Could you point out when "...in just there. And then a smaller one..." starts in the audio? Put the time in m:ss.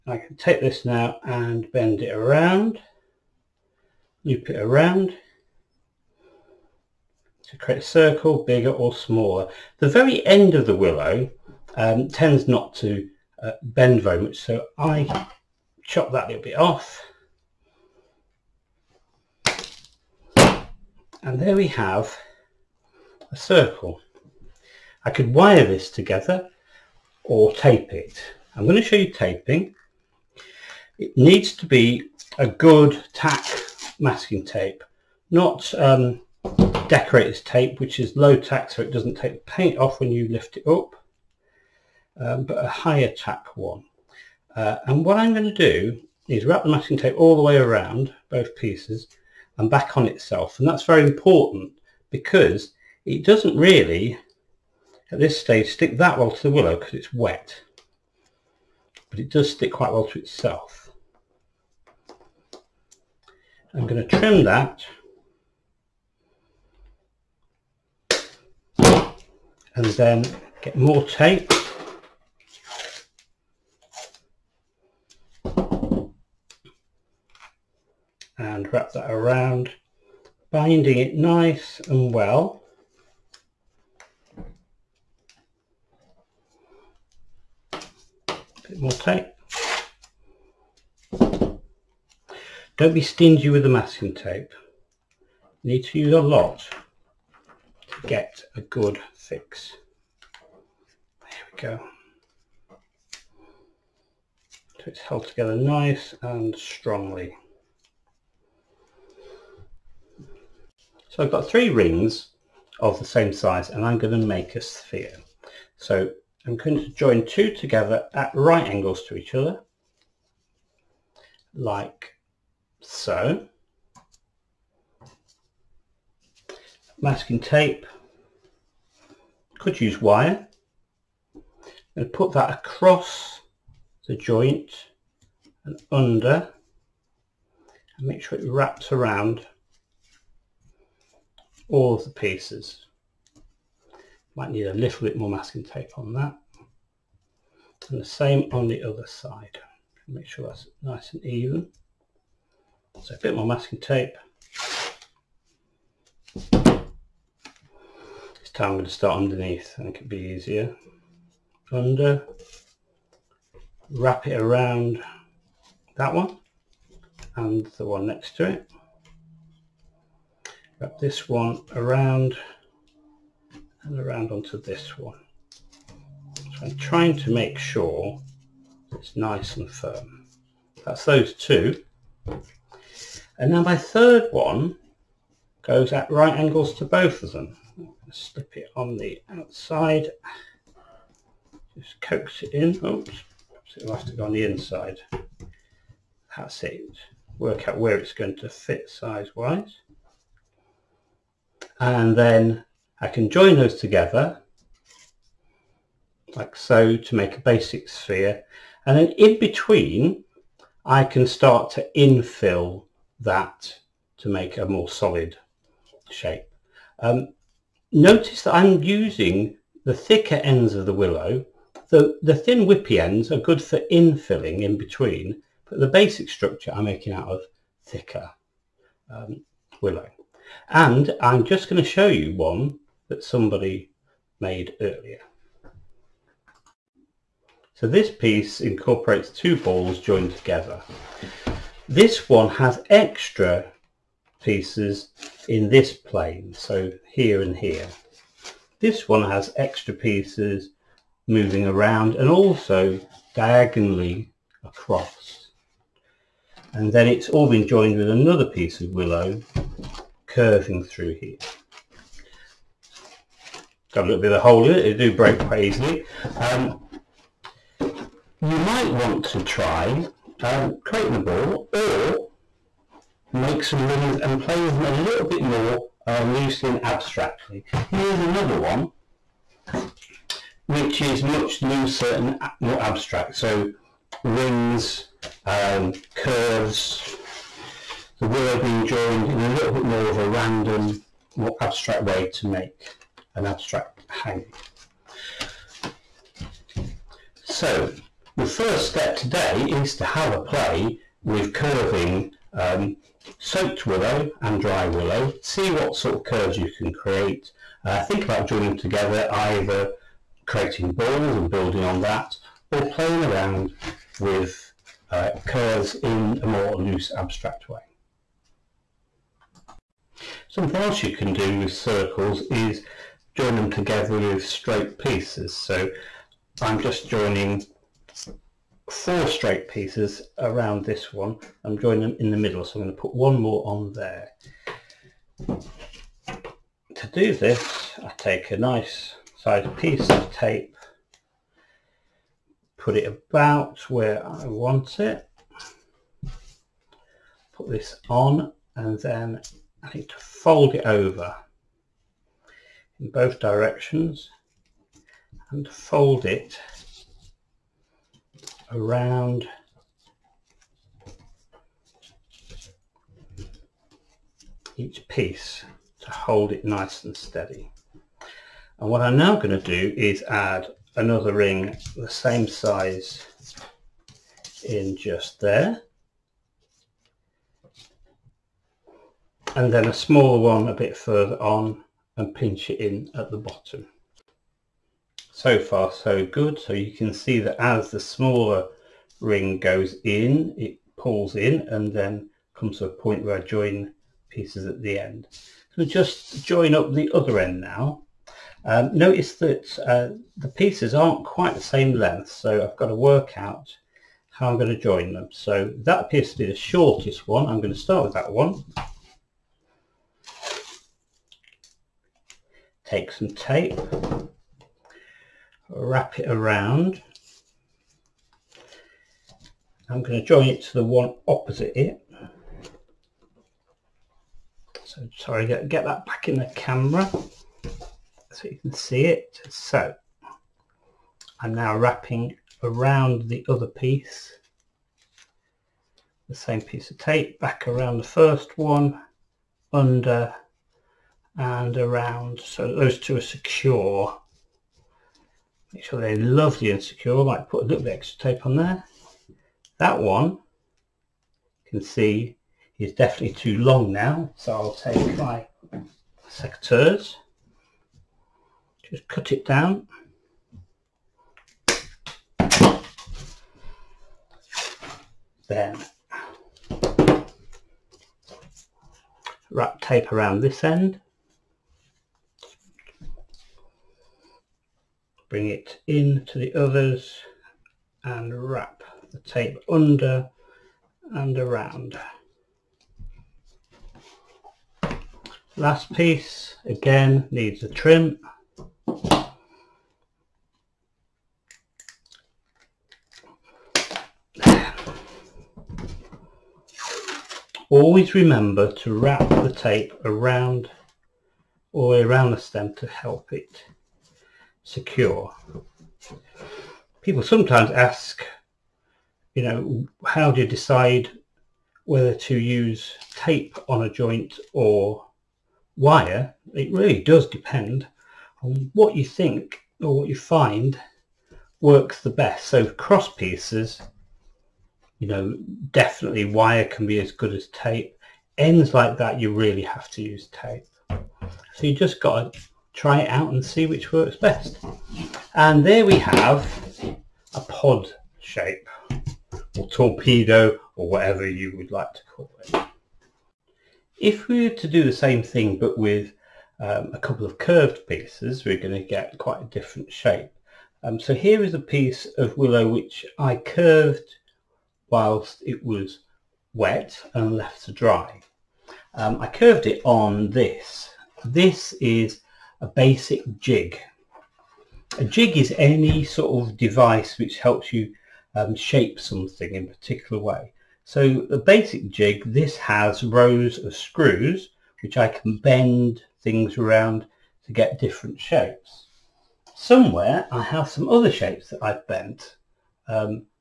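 6:14.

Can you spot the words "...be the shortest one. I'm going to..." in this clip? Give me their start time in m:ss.
6:46.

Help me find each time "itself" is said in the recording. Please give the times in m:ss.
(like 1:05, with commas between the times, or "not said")
0:50, 1:00.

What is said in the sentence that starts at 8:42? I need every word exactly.
So cross pieces, you know, definitely wire can be as good as tape.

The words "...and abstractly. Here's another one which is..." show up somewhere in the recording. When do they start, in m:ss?
4:36.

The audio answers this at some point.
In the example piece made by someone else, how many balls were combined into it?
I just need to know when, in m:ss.
3:59.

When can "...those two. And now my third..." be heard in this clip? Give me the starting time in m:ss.
3:01.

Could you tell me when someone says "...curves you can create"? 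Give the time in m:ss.
5:06.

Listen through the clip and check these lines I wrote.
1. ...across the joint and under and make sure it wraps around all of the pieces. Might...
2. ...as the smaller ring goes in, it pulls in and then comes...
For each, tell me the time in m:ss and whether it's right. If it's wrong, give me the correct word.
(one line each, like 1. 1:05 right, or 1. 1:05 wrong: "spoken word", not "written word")
1. 2:12 right
2. 6:27 right.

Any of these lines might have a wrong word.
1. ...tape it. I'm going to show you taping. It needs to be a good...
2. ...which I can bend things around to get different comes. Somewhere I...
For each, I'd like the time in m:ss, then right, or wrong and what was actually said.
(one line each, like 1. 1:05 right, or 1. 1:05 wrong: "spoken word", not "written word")
1. 0:27 right
2. 9:34 wrong: "shapes", not "comes".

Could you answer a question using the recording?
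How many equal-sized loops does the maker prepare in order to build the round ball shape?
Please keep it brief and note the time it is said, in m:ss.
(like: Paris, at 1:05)
3, at 1:51.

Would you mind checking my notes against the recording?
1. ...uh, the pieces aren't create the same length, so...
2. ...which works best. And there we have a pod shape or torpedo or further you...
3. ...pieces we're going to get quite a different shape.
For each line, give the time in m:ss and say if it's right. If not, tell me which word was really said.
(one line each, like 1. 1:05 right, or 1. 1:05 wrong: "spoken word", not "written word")
1. 6:39 wrong: "quite", not "create"
2. 8:53 wrong: "whatever", not "further"
3. 9:07 right.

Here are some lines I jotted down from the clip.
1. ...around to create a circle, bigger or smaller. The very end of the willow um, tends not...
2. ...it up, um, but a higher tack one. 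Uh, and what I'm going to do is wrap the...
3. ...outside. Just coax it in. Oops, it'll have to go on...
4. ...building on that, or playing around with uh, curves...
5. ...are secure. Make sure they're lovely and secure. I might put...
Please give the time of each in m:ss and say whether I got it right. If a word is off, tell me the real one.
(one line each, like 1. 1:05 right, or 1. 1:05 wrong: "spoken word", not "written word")
1. 0:04 right
2. 0:40 right
3. 3:09 right
4. 5:11 right
5. 7:23 right.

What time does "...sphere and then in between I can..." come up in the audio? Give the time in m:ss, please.
3:27.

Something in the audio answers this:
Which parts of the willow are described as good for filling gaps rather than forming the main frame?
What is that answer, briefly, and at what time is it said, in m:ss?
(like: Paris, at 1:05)
thin whippy ends, at 3:42.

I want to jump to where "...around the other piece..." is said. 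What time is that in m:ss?
7:12.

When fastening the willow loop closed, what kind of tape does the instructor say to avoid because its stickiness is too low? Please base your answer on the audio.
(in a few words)
decorator's tape.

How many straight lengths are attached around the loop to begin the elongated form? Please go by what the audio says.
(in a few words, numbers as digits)
4.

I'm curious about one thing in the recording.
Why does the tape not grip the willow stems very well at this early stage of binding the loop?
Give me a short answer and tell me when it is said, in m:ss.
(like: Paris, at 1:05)
because it's wet, at 0:56.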